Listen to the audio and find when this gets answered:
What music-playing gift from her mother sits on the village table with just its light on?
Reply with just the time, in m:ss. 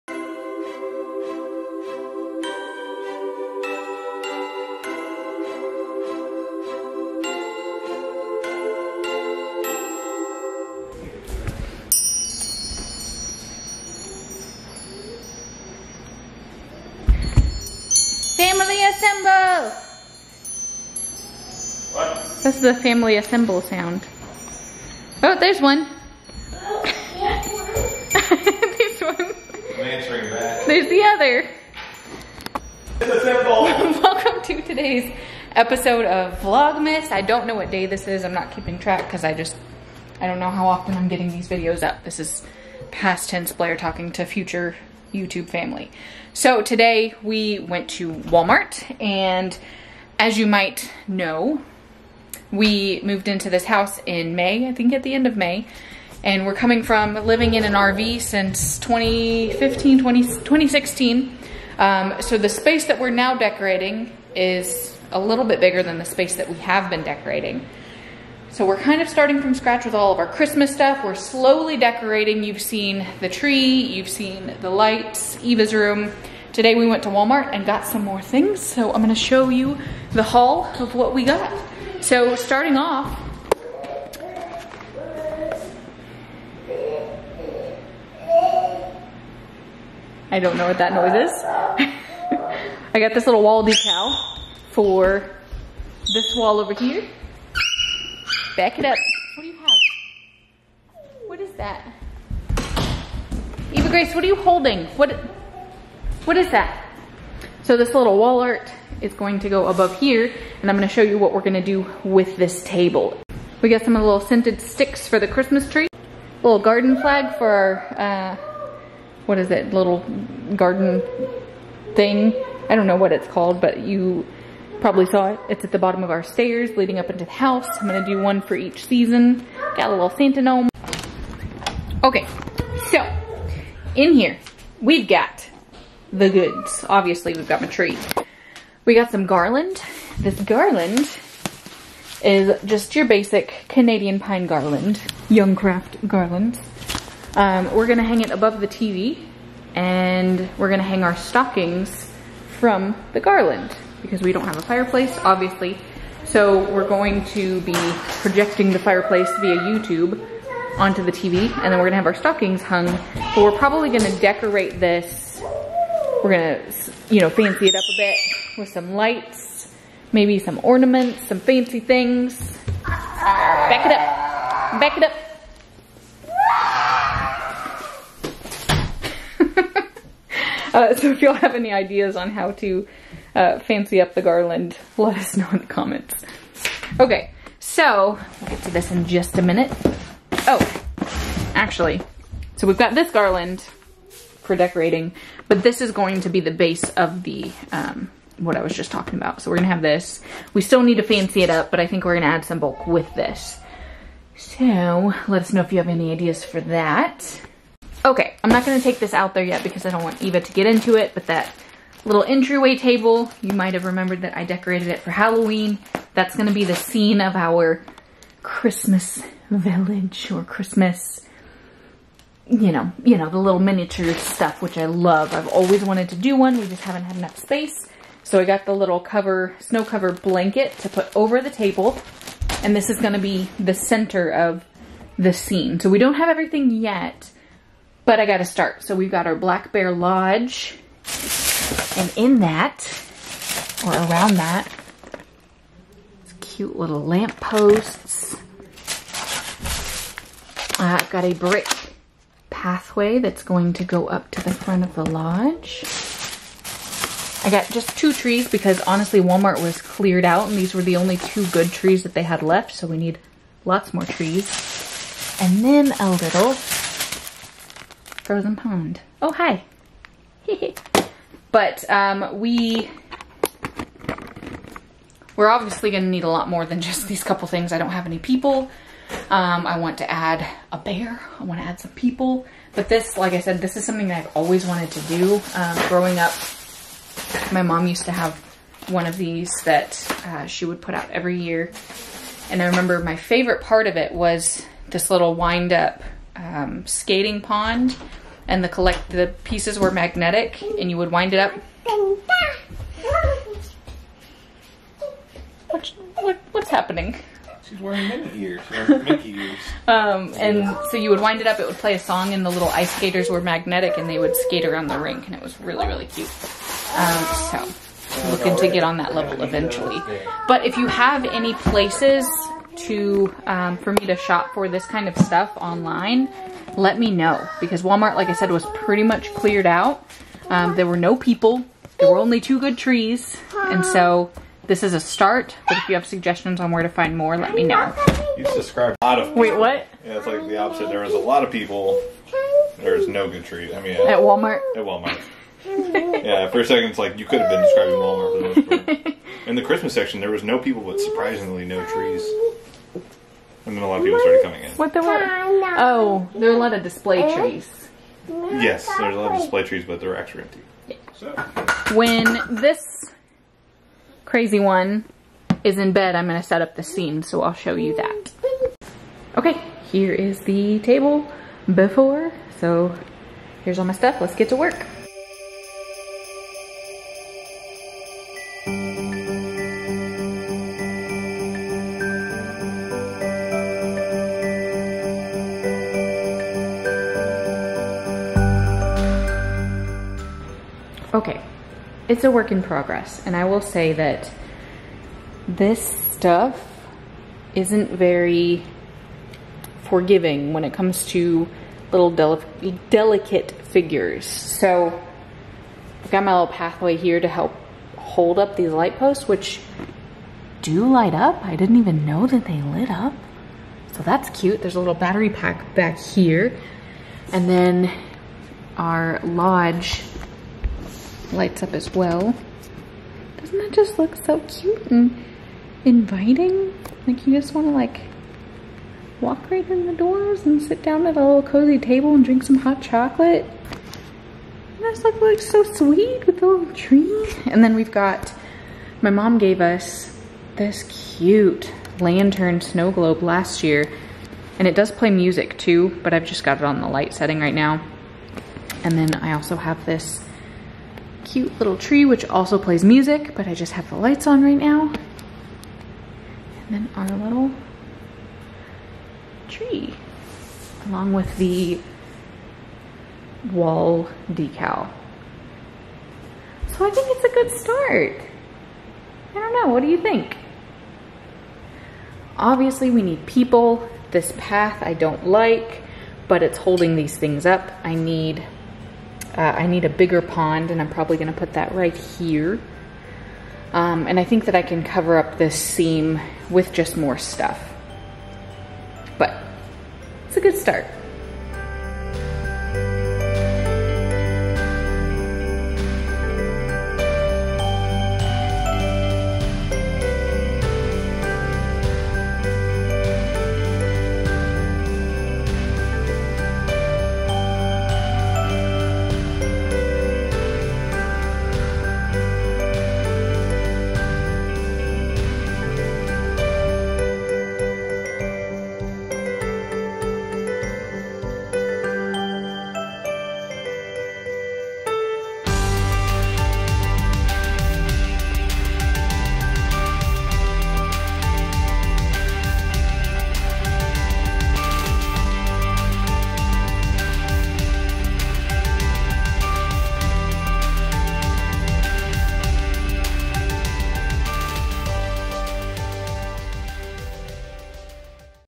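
7:21.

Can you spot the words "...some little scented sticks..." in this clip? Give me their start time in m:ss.
1:53.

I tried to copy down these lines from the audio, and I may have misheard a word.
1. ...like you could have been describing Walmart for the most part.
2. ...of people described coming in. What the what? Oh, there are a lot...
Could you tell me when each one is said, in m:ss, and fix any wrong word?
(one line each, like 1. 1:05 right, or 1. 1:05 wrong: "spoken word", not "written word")
1. 5:46 right
2. 5:53 wrong: "started", not "described".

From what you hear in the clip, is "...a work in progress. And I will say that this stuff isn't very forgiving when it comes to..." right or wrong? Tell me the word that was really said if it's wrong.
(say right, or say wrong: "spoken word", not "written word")
right.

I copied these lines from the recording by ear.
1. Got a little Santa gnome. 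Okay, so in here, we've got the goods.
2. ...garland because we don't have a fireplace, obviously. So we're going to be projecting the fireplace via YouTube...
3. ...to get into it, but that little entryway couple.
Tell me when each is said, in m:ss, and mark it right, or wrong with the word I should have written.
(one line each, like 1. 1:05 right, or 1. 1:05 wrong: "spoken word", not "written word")
1. 2:09 right
2. 2:33 right
3. 3:30 wrong: "table", not "couple".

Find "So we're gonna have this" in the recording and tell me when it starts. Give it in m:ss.
3:19.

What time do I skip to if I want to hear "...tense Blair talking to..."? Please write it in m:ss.
0:43.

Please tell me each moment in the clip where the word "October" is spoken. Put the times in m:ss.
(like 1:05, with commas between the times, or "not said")
not said.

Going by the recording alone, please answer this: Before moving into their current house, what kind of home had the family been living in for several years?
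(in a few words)
an RV.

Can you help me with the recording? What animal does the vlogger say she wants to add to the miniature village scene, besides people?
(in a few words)
a bear.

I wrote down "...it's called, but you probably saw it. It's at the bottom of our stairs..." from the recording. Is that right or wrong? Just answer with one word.
right.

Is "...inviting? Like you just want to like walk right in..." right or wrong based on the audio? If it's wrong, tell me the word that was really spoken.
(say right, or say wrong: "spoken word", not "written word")
right.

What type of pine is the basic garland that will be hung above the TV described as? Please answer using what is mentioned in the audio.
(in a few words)
Canadian pine.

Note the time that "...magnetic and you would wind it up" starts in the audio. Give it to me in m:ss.
4:59.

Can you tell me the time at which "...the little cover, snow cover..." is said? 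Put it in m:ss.
3:48.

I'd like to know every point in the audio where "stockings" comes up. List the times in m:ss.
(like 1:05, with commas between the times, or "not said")
2:31, 2:42.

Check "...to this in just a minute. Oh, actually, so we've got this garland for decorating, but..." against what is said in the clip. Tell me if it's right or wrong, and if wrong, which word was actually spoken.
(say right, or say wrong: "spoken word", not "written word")
right.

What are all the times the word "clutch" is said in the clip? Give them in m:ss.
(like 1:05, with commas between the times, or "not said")
not said.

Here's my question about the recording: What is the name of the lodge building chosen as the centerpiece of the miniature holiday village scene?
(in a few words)
Black Bear Lodge.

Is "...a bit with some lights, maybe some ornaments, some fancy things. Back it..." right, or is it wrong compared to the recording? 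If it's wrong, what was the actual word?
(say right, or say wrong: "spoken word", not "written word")
right.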